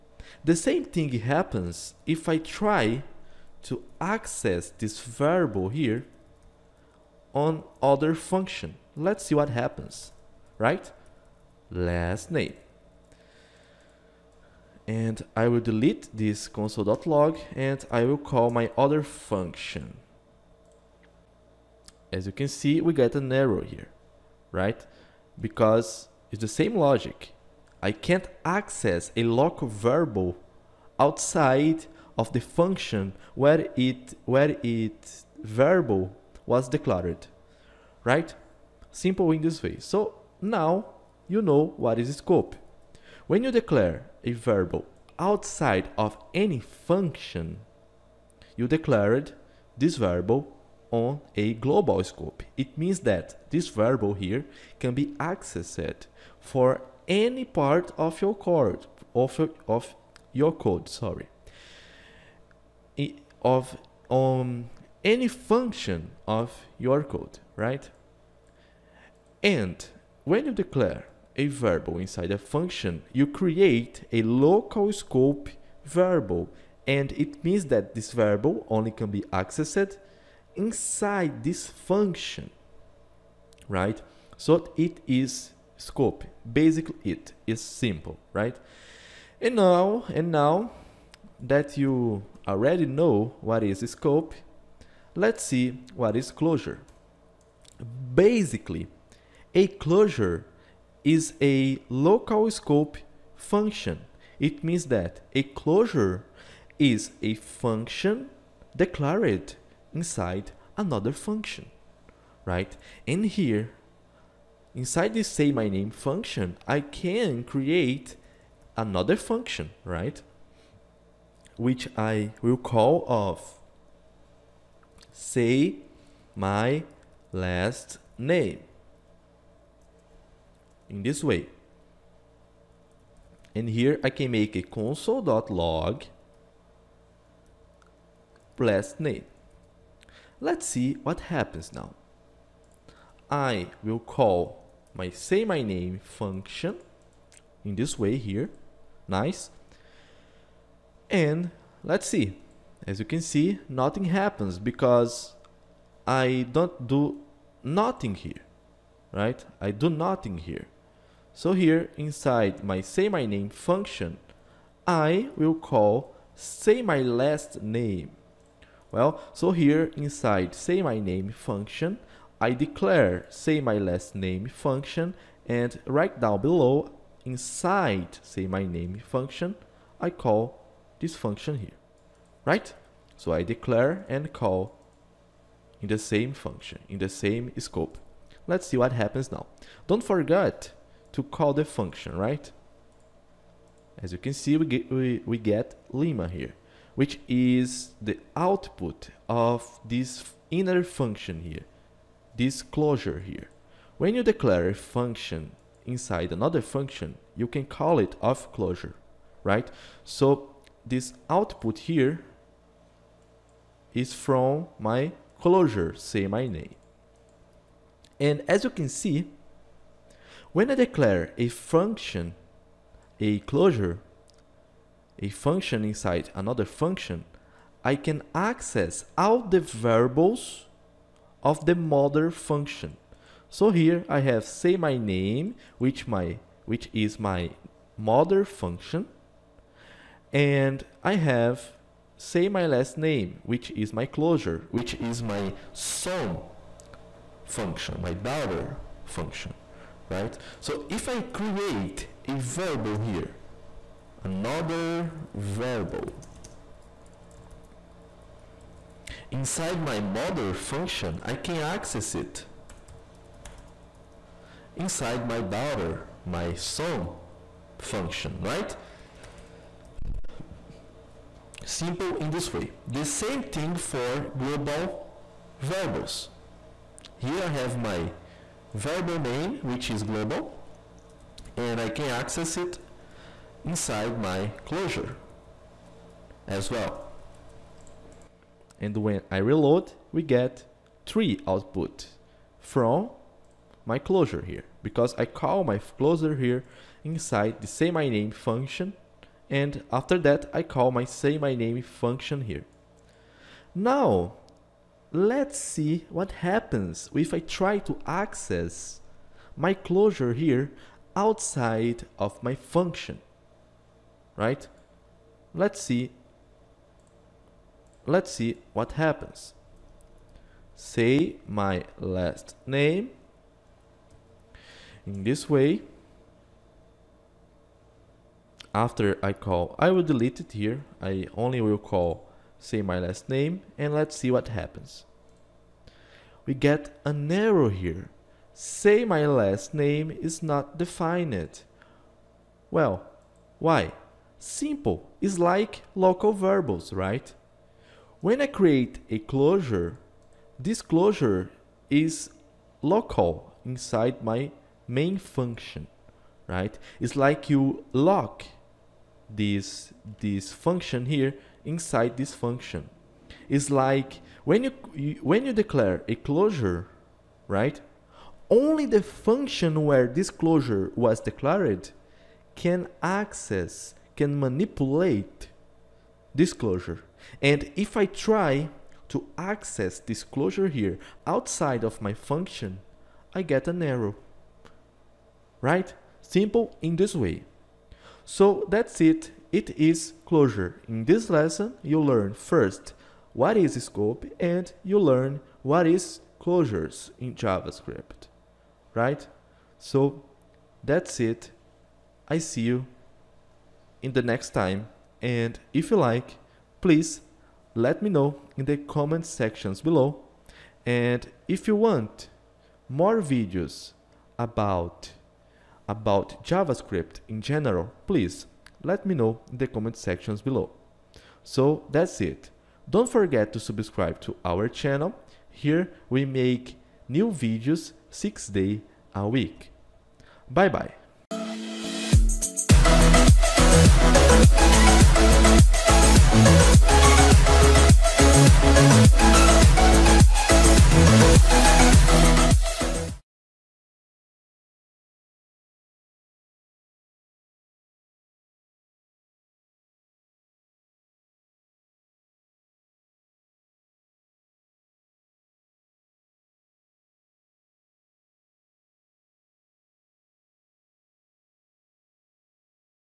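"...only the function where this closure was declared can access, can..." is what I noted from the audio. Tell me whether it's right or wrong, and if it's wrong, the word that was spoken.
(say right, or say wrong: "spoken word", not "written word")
right.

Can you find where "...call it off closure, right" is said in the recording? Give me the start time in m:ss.
3:27.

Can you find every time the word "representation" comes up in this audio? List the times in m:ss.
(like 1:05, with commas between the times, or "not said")
not said.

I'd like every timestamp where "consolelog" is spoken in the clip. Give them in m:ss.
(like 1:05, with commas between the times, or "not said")
0:16, 2:14.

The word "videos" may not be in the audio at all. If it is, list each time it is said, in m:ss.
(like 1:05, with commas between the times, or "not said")
6:53, 7:07.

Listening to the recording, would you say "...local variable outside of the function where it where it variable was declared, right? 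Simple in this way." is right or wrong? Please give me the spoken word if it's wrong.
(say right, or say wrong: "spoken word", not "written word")
right.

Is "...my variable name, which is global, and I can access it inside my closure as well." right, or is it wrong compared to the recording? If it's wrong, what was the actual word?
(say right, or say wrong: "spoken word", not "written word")
right.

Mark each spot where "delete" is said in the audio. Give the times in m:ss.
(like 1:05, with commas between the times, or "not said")
0:15, 5:30.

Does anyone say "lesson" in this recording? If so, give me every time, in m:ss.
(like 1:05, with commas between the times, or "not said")
6:31.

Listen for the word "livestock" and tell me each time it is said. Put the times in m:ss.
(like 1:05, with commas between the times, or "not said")
not said.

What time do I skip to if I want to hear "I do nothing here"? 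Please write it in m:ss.
2:39.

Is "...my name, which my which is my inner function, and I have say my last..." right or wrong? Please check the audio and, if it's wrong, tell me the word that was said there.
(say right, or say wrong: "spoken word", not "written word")
wrong: "mother", not "inner".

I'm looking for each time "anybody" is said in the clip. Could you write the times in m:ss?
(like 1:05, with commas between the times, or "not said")
not said.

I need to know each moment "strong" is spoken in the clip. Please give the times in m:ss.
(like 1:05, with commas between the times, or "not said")
not said.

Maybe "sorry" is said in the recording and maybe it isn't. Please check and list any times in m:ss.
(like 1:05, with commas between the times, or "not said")
1:00.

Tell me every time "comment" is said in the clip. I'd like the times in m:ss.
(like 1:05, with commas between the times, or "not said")
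6:48, 6:59.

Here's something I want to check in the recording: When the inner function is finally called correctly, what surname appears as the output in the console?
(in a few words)
Lima.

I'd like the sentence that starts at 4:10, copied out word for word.
So if I create a verbal here, another verbal, inside my mother function, I can access it.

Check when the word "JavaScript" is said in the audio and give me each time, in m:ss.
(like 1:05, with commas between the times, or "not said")
6:37, 6:56.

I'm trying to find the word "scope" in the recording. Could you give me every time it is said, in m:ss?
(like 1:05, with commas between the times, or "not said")
0:42, 0:52, 1:14, 1:25, 1:33, 1:42, 3:07, 6:33.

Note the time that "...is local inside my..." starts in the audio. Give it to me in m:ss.
5:51.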